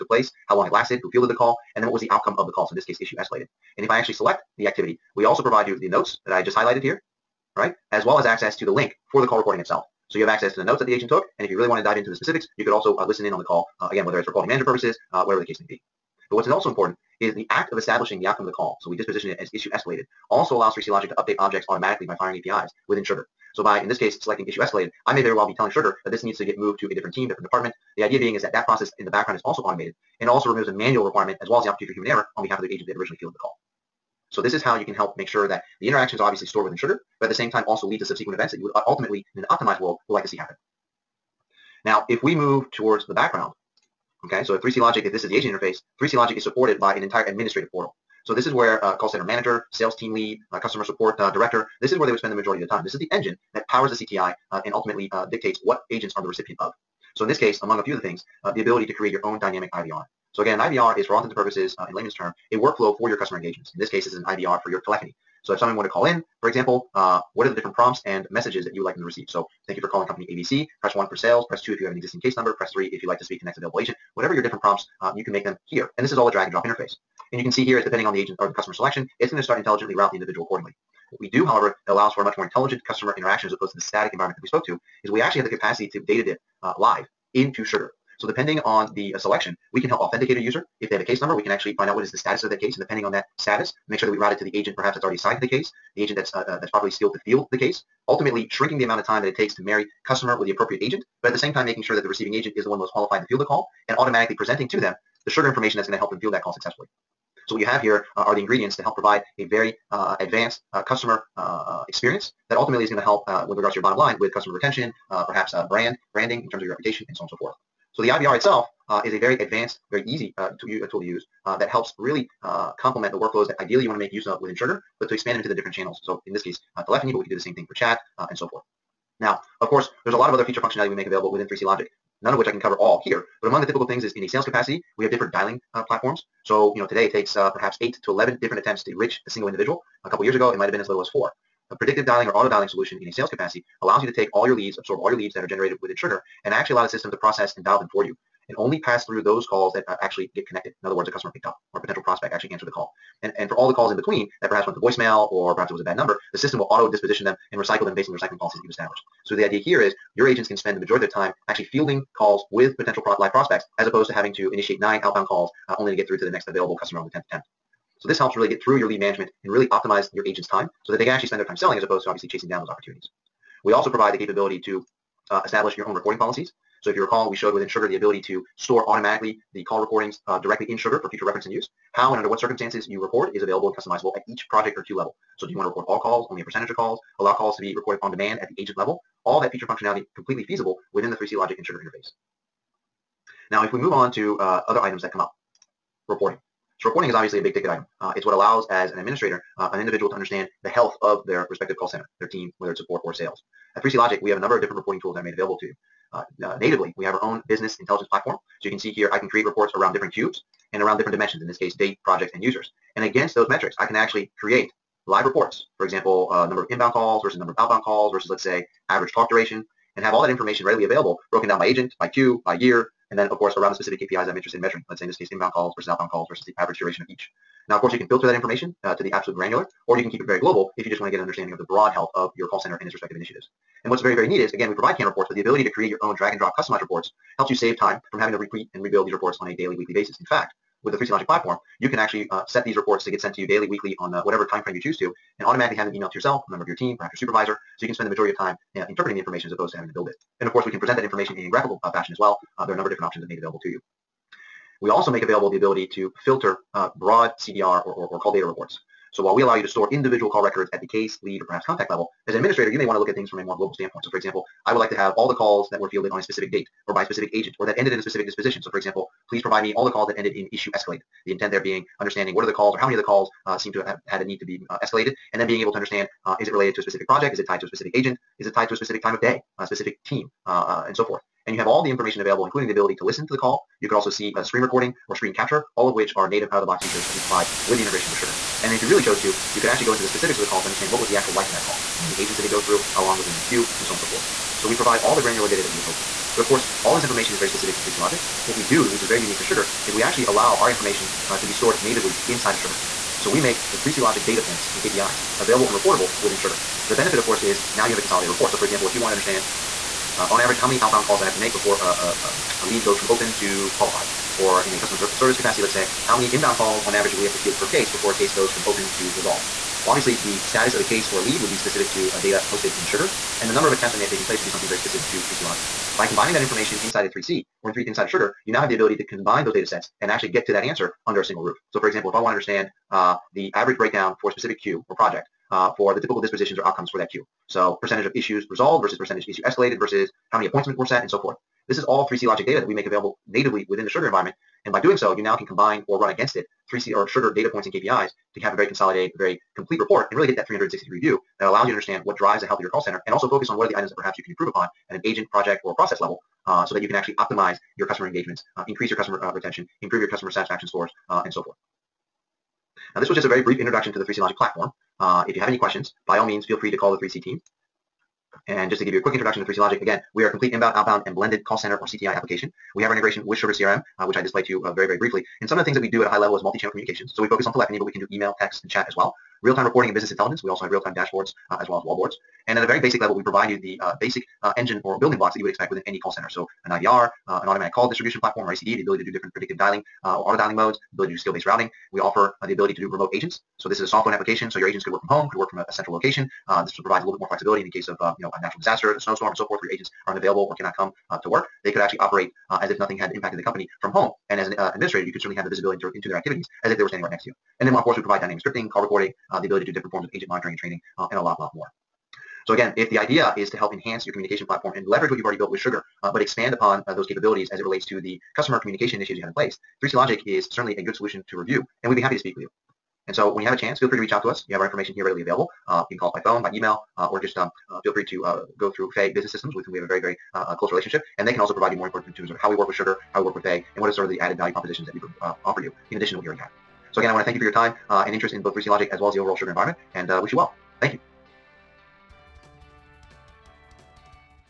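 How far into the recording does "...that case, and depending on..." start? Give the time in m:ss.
1:32.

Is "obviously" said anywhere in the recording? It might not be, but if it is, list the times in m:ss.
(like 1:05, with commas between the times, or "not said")
0:36, 2:52, 3:17, 5:19.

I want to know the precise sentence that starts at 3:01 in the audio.
How and under what circumstances you record is available and customizable at each project or queue level.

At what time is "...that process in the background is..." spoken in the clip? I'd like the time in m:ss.
0:28.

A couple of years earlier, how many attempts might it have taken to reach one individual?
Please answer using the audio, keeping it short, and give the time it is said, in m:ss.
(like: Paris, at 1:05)
4, at 2:21.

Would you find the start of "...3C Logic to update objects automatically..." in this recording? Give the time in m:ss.
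0:20.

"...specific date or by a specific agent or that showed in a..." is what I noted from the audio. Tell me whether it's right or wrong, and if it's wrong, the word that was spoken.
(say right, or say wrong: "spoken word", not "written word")
wrong: "ended", not "showed".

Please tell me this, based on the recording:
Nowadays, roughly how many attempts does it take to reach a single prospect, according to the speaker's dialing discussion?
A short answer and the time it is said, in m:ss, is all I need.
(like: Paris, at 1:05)
8 to 11, at 2:17.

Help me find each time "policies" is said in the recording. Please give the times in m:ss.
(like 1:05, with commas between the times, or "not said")
2:38, 2:56.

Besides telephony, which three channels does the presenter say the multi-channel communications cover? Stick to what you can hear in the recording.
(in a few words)
Email, text, and chat.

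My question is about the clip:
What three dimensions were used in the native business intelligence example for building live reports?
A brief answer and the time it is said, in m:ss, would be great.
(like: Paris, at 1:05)
Date, projects, and users, at 3:31.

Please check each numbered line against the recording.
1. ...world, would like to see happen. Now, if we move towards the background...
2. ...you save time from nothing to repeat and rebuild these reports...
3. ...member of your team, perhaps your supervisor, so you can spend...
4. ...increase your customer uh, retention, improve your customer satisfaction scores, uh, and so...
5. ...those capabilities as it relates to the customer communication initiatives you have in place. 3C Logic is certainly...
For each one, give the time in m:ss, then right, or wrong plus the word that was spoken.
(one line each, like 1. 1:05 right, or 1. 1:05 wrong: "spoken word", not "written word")
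1. 0:39 right
2. 3:57 wrong: "having", not "nothing"
3. 4:06 right
4. 5:58 right
5. 6:56 right.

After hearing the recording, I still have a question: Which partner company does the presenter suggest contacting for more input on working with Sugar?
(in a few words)
Faye Business Systems.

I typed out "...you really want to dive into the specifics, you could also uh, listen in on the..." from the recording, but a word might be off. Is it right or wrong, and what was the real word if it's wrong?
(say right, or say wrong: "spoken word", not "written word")
right.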